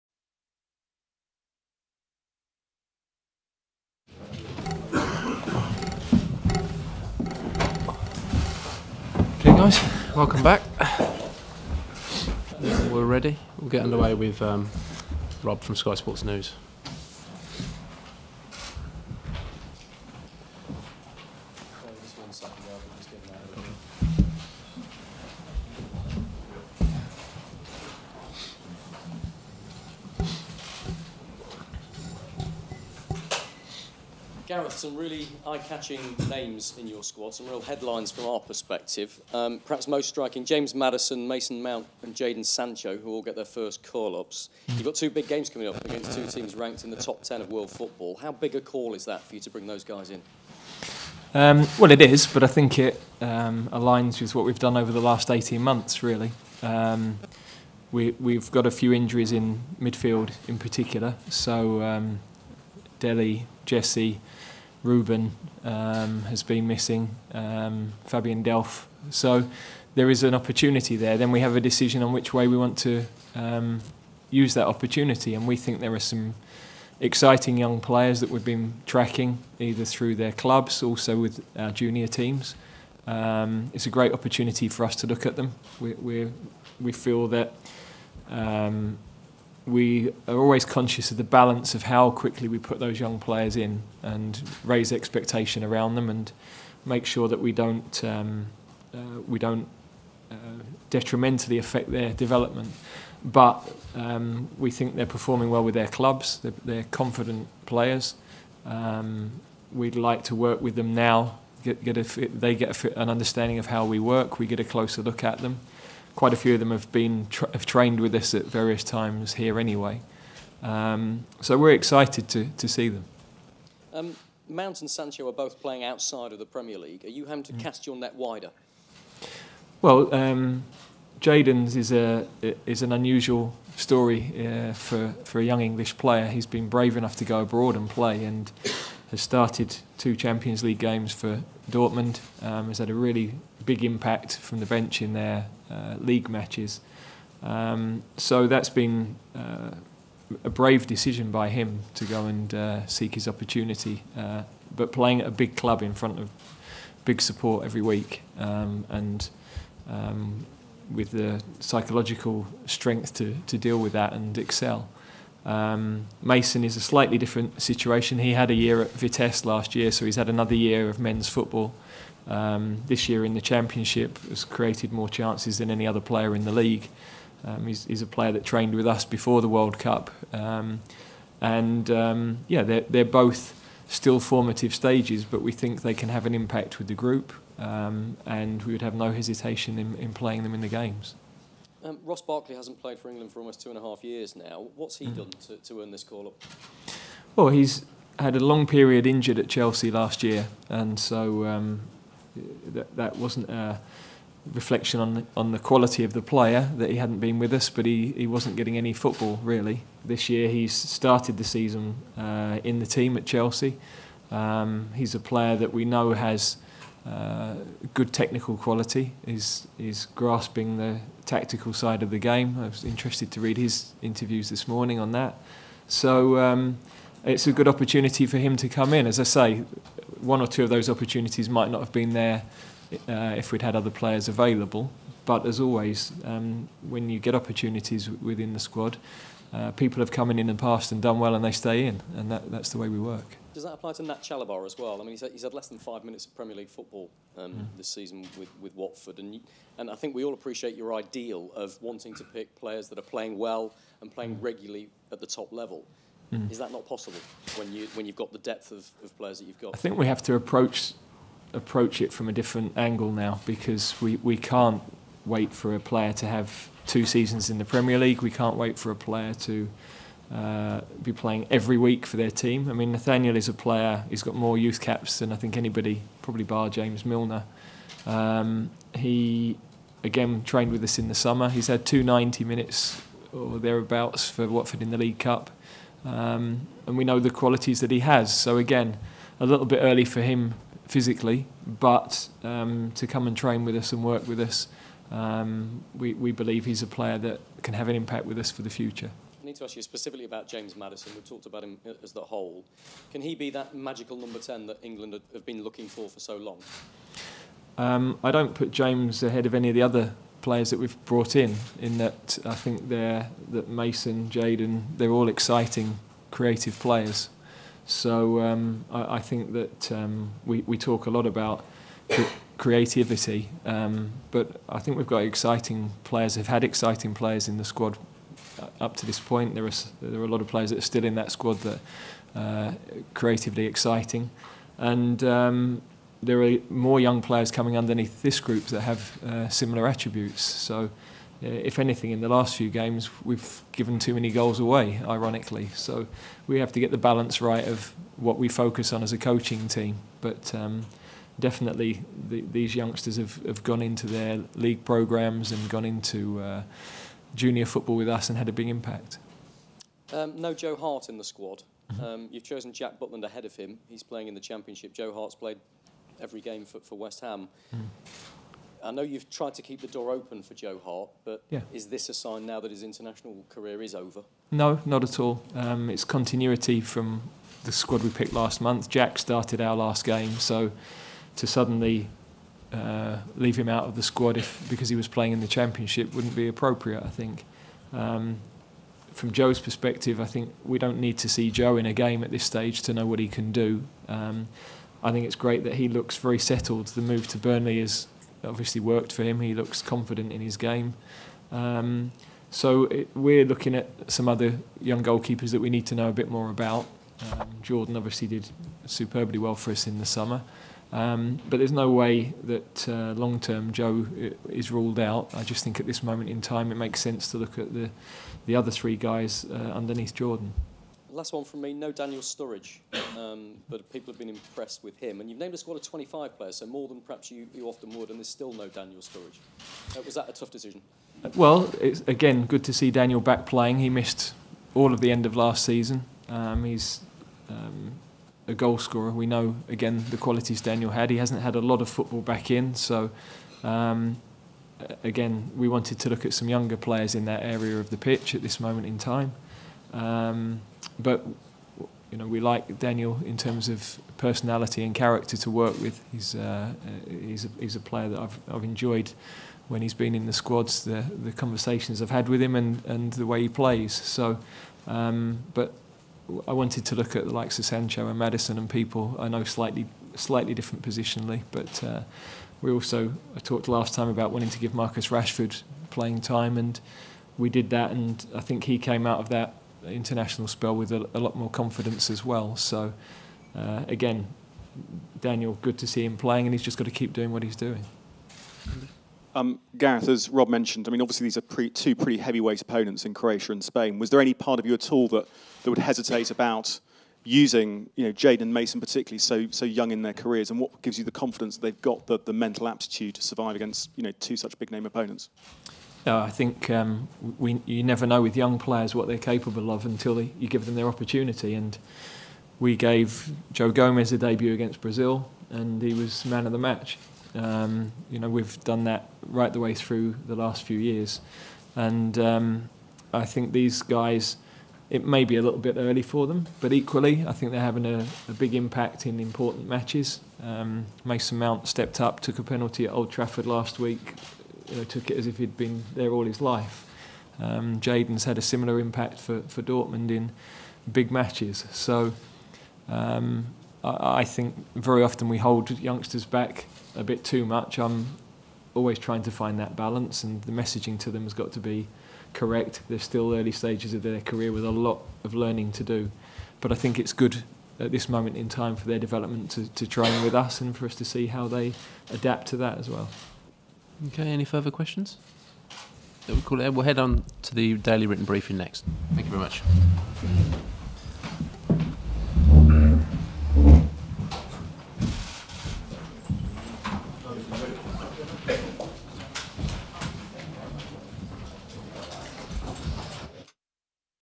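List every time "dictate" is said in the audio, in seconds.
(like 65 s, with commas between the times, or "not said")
not said.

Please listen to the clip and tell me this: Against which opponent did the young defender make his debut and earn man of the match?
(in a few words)
Brazil.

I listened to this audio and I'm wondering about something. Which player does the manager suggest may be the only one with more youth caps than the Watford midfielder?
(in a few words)
James Milner.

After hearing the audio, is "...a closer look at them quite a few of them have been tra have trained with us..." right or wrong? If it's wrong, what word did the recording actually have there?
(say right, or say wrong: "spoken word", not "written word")
right.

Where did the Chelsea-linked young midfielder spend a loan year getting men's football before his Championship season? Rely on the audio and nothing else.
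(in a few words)
Vitesse.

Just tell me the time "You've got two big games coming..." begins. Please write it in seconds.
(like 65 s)
44 s.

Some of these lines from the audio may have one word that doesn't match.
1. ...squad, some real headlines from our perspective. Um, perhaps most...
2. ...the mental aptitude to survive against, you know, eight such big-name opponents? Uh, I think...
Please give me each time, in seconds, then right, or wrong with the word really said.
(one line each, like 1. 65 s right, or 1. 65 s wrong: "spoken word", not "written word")
1. 37 s right
2. 502 s wrong: "two", not "eight".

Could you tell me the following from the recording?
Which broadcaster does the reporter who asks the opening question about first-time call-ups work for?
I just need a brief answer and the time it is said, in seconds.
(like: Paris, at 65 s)
Sky Sports News, at 15 s.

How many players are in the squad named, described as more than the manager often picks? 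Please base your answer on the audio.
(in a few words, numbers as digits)
25.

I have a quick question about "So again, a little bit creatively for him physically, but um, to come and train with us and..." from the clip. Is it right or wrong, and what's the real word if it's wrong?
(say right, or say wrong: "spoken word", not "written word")
wrong: "early", not "creatively".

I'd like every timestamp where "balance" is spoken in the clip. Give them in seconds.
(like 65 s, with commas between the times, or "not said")
91 s, 346 s, 549 s.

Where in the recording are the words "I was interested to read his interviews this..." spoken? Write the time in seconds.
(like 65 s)
222 s.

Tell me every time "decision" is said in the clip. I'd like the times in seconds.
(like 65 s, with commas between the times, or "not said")
71 s, 150 s, 430 s.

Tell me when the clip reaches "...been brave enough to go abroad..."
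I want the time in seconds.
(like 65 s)
136 s.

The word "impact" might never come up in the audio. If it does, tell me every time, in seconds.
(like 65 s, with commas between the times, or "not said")
143 s, 186 s, 297 s, 358 s, 528 s, 538 s.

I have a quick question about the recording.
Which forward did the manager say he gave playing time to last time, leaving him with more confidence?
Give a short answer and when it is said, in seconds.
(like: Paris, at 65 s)
Marcus Rashford, at 474 s.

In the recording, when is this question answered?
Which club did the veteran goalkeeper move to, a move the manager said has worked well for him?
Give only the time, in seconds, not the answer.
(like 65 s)
397 s.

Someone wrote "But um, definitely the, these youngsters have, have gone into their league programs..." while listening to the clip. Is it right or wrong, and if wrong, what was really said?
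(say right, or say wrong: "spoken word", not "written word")
right.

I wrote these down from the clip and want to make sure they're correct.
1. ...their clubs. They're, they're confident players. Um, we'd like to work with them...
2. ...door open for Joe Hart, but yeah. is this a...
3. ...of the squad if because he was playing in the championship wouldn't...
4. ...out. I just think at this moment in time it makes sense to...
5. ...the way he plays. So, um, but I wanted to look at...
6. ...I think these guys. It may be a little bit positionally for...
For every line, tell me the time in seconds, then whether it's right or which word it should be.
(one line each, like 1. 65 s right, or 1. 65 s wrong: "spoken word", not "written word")
1. 105 s right
2. 369 s right
3. 383 s right
4. 414 s right
5. 463 s right
6. 523 s wrong: "early", not "positionally".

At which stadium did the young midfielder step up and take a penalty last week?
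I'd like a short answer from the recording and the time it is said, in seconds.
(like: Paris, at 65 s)
Old Trafford, at 532 s.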